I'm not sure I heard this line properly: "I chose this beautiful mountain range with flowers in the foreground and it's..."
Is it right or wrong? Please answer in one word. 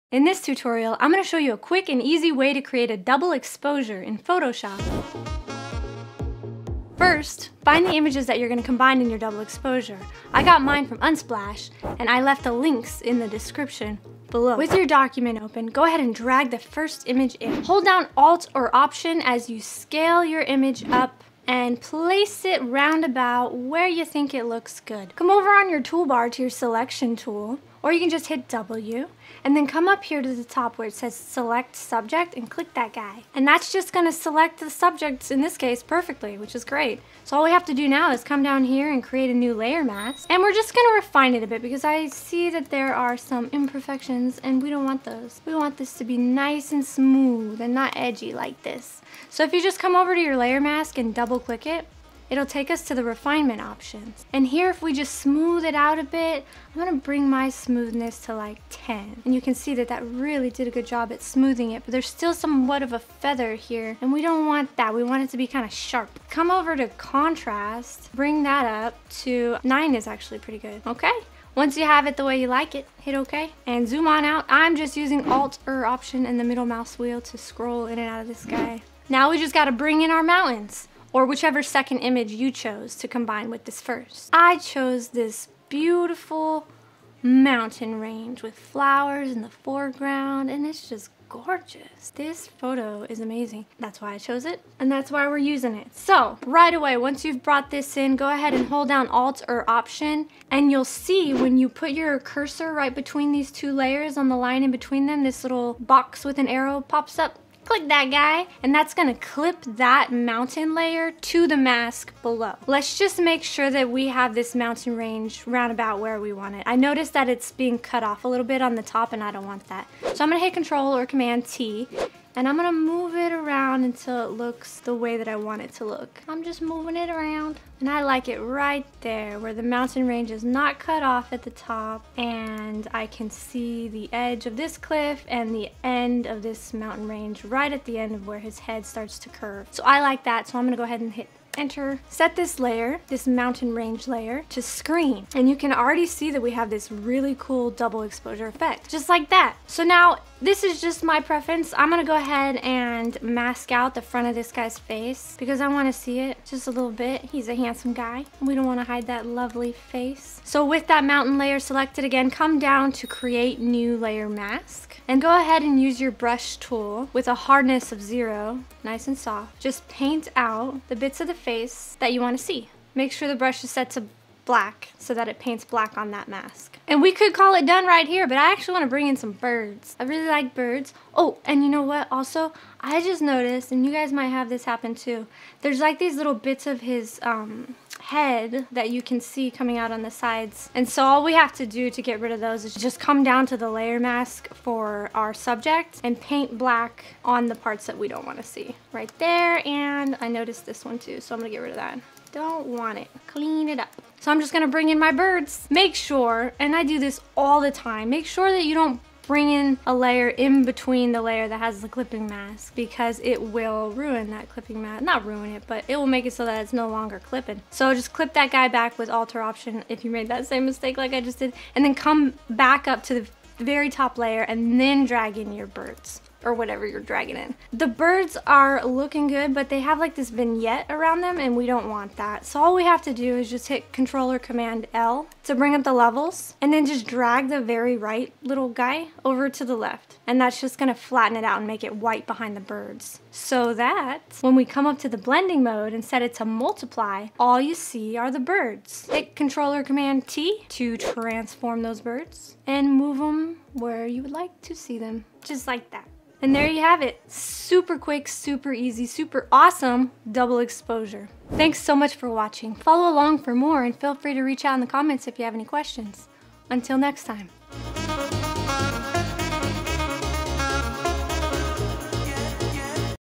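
right.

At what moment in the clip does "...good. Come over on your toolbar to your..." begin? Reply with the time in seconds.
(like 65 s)
24 s.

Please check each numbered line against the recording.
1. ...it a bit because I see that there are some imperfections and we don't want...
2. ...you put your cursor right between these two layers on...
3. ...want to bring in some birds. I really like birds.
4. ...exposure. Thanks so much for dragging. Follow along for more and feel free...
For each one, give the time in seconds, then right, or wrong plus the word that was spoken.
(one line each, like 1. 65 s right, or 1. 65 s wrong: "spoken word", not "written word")
1. 41 s right
2. 101 s right
3. 178 s right
4. 260 s wrong: "watching", not "dragging".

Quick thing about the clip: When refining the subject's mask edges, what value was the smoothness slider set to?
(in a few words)
10.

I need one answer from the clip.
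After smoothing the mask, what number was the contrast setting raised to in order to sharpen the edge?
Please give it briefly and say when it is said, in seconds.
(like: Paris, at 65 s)
9, at 69 s.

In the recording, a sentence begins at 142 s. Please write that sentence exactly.
Set this layer, this mountain range layer, to screen.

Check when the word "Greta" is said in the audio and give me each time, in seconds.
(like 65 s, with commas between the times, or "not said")
not said.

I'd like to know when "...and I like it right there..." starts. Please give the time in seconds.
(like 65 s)
127 s.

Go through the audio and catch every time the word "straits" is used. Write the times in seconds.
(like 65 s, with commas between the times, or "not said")
not said.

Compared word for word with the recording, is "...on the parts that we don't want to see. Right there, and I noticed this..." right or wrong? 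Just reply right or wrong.
right.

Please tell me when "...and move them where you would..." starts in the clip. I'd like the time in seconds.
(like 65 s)
252 s.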